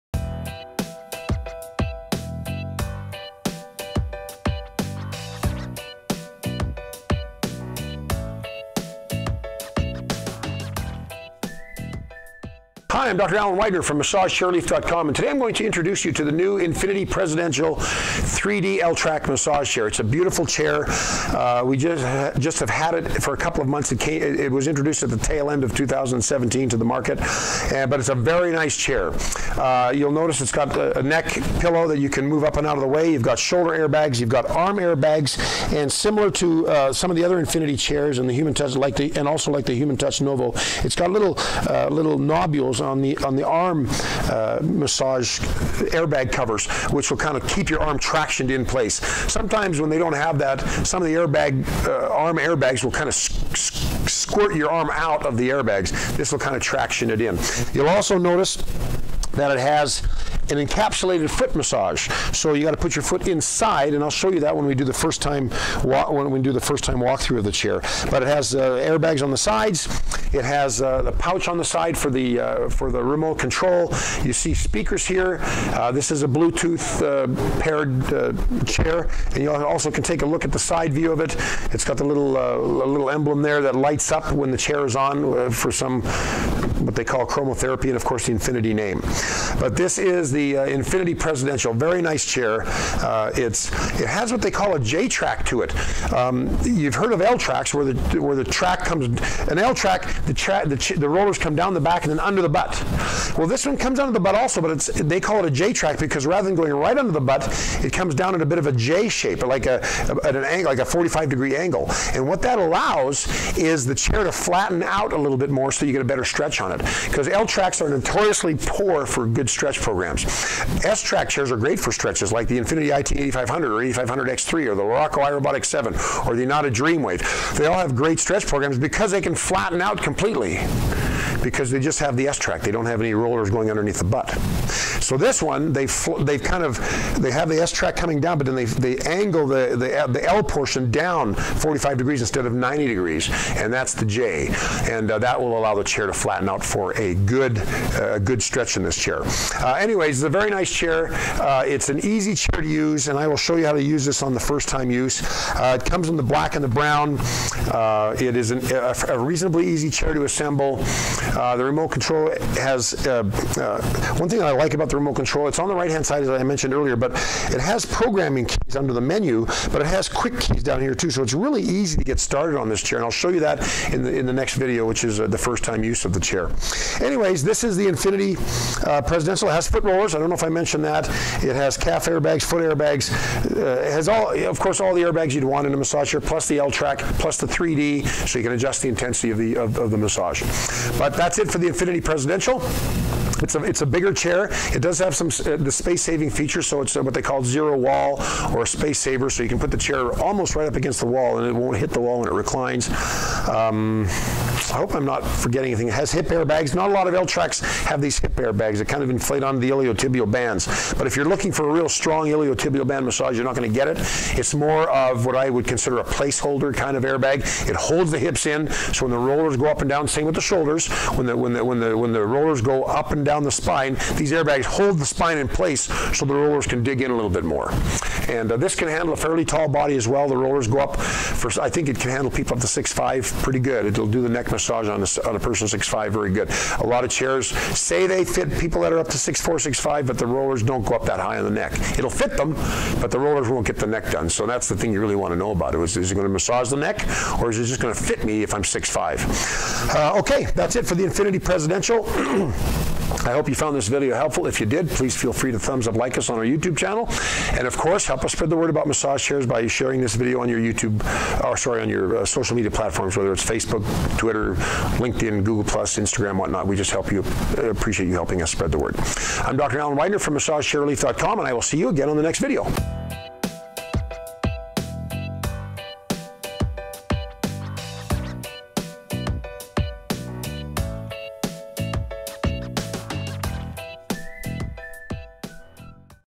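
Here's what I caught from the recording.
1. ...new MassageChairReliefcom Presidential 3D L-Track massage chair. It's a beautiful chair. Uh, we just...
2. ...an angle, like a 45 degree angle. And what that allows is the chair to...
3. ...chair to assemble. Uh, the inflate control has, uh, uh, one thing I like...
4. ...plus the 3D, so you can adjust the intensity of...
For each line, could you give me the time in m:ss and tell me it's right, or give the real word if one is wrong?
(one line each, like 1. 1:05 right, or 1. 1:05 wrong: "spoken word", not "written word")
1. 0:16 wrong: "Infinity", not "MassageChairReliefcom"
2. 1:50 right
3. 2:39 wrong: "remote", not "inflate"
4. 3:07 right.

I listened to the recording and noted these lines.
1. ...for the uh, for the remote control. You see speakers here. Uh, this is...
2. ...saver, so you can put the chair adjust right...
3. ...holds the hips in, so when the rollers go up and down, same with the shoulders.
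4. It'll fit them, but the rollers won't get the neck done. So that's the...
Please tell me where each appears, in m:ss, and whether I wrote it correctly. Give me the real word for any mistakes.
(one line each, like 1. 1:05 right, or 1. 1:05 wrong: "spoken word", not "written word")
1. 1:11 right
2. 3:18 wrong: "almost", not "adjust"
3. 3:37 right
4. 4:01 right.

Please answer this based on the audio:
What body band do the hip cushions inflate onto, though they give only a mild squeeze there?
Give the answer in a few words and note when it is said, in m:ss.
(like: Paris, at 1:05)
iliotibial bands, at 3:29.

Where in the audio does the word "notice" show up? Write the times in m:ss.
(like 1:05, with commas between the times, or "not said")
0:30, 0:58.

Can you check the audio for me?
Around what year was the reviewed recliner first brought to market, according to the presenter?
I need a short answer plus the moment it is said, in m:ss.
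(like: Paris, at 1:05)
2017, at 0:25.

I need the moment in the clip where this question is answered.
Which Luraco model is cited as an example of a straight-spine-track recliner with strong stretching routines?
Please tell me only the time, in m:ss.
2:05.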